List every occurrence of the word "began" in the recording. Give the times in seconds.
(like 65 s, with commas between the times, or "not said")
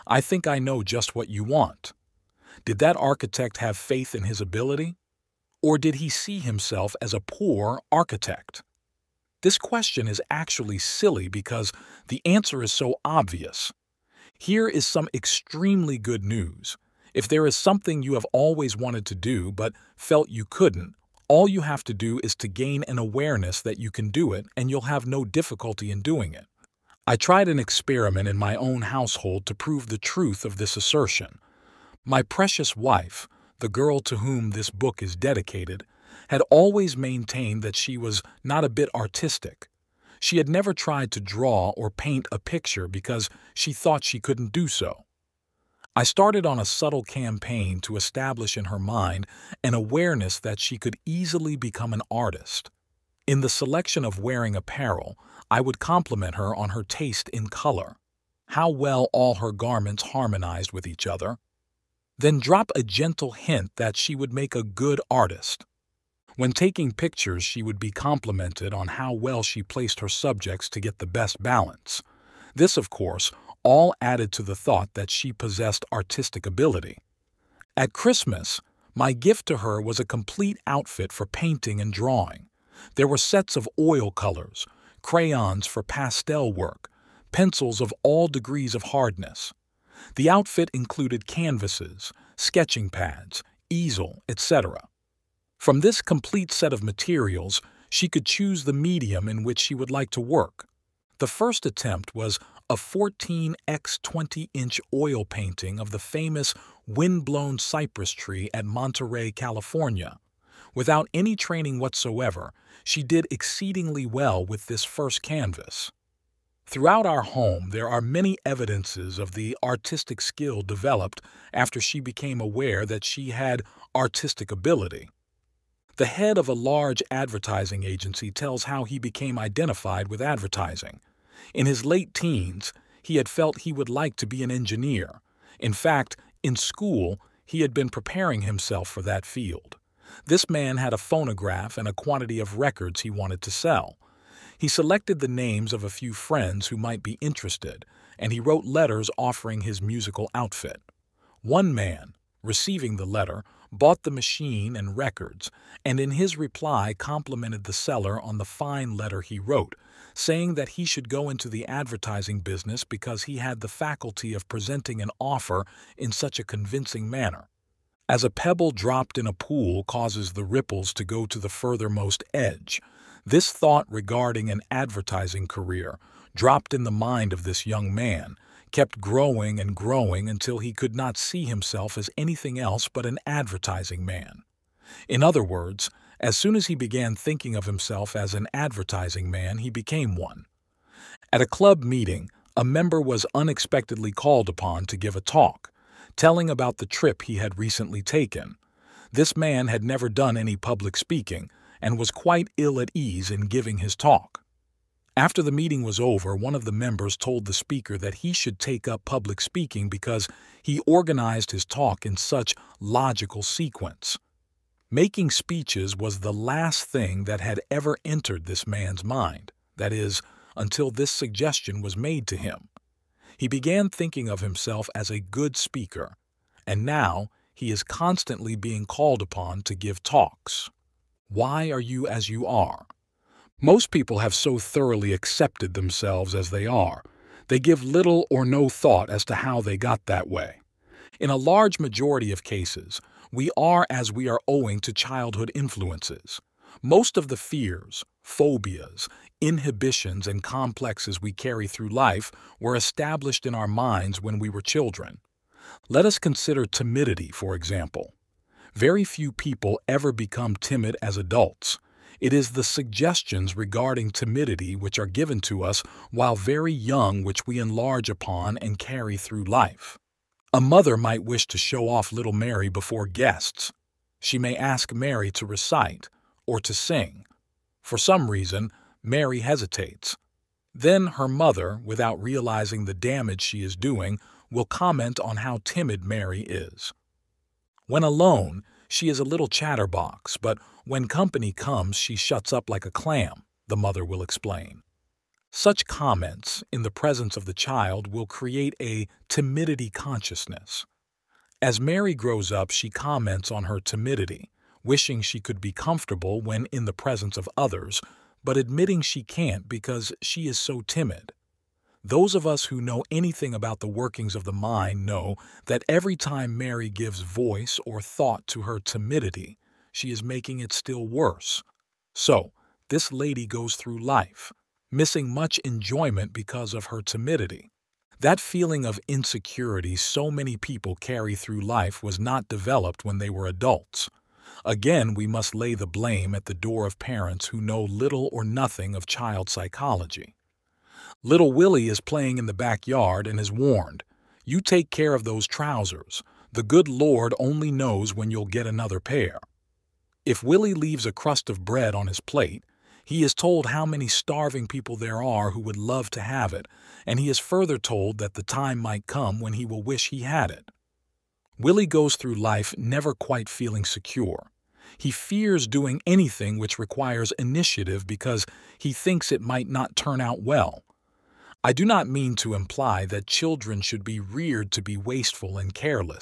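186 s, 223 s.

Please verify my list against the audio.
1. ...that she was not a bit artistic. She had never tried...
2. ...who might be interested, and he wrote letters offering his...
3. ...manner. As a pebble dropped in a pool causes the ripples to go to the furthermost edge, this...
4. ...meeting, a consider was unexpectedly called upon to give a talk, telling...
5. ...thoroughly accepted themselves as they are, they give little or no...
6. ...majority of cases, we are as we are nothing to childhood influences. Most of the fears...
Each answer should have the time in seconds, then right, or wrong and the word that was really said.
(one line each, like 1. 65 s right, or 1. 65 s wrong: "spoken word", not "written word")
1. 37 s right
2. 146 s right
3. 167 s right
4. 191 s wrong: "member", not "consider"
5. 234 s right
6. 241 s wrong: "owing", not "nothing".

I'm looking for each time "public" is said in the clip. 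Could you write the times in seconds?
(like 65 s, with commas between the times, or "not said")
200 s, 209 s.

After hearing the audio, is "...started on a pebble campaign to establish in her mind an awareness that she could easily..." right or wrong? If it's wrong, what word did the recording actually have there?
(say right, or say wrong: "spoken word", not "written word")
wrong: "subtle", not "pebble".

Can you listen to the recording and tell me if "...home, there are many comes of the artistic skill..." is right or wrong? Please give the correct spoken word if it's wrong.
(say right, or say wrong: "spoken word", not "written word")
wrong: "evidences", not "comes".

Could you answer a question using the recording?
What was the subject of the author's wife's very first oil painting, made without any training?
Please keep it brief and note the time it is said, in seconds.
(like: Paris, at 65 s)
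Windblown cypress tree at Monterey, at 106 s.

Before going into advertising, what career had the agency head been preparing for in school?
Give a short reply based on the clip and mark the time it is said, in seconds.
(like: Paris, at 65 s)
Engineer, at 134 s.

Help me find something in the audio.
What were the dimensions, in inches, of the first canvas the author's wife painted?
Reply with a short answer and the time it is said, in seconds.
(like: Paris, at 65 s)
14x20, at 102 s.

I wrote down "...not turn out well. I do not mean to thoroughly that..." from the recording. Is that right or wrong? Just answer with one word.
wrong.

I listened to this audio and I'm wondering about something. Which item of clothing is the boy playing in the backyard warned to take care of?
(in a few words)
Trousers.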